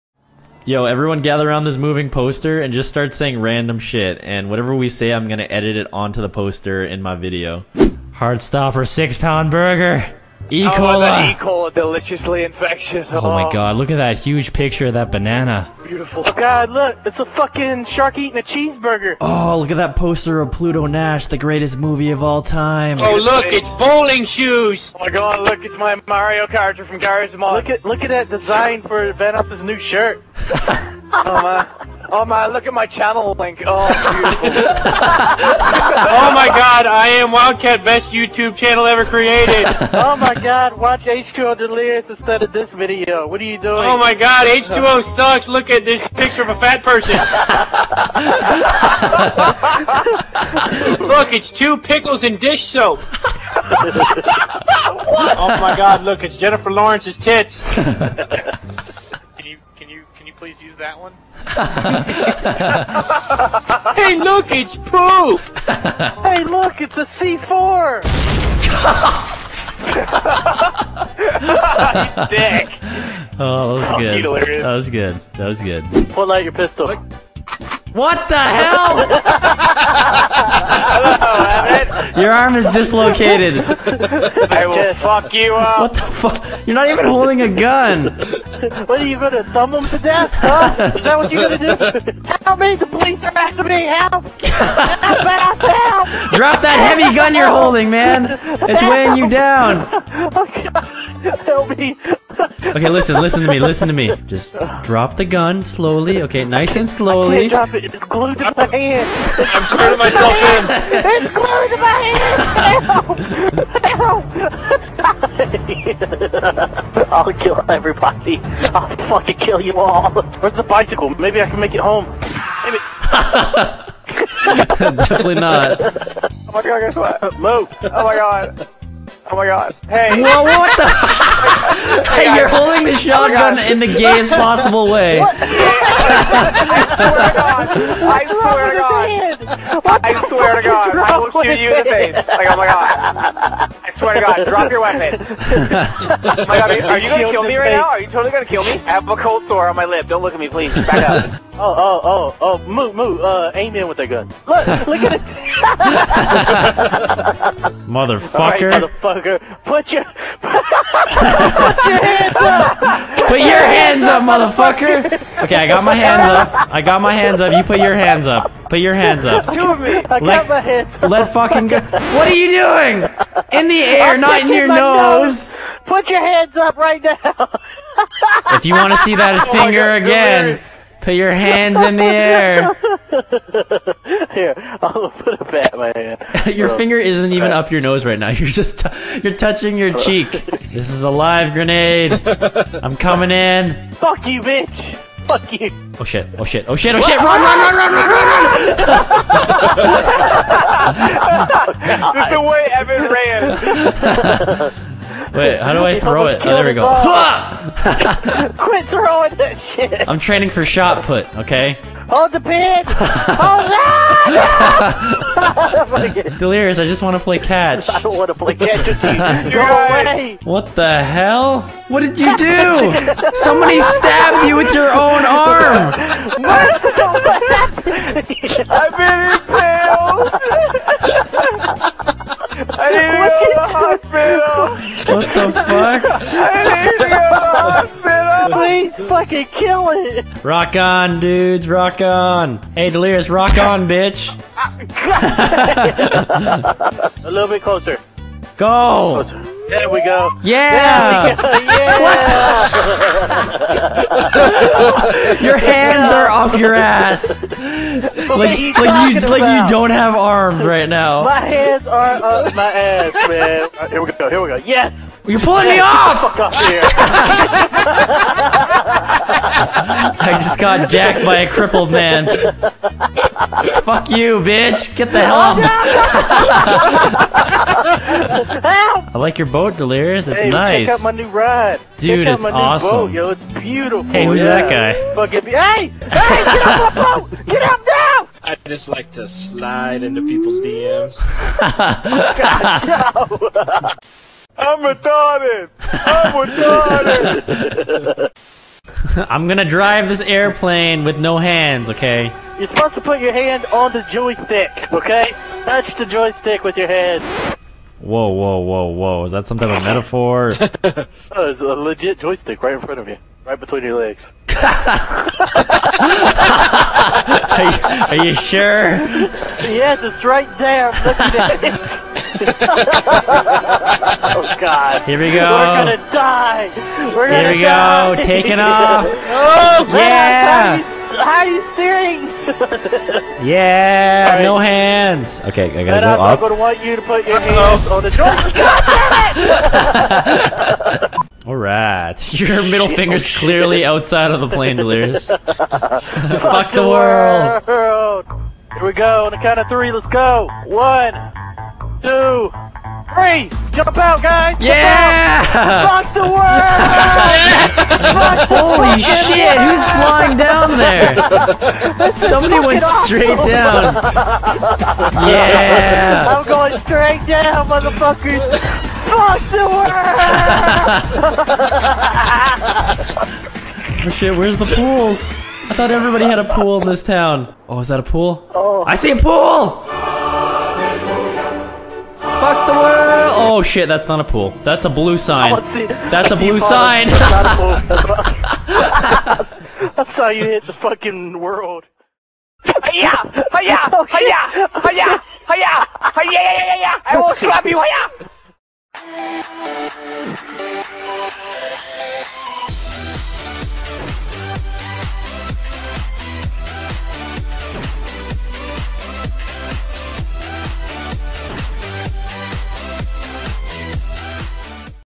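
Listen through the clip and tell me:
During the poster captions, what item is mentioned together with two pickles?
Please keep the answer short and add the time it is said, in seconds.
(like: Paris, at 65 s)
Dish soap, at 52 s.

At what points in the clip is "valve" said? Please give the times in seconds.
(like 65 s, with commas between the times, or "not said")
not said.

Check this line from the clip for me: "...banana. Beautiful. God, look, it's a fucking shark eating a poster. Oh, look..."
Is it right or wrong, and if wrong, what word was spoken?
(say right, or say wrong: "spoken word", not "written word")
wrong: "cheeseburger", not "poster".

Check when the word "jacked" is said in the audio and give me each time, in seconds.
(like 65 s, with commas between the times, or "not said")
270 s.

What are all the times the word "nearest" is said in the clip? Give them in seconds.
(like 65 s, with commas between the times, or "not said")
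not said.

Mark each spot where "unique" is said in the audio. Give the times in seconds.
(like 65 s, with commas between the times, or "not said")
not said.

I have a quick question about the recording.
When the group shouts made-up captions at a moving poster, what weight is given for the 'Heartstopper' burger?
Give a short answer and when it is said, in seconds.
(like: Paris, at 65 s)
6 pound, at 8 s.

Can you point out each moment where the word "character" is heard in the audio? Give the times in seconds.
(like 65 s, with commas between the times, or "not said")
26 s.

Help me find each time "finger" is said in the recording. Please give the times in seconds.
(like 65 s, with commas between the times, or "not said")
179 s, 186 s, 342 s.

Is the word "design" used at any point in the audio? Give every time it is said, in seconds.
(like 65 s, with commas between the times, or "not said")
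28 s.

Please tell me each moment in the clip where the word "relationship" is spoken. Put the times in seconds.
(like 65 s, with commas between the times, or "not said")
not said.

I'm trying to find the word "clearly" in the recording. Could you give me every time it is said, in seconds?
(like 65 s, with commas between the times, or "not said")
343 s.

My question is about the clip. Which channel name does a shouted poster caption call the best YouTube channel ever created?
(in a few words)
Wildcat.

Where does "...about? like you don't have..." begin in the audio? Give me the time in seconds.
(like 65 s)
259 s.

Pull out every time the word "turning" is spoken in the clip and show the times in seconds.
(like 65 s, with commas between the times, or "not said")
109 s.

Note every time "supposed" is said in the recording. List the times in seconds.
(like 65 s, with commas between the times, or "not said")
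302 s.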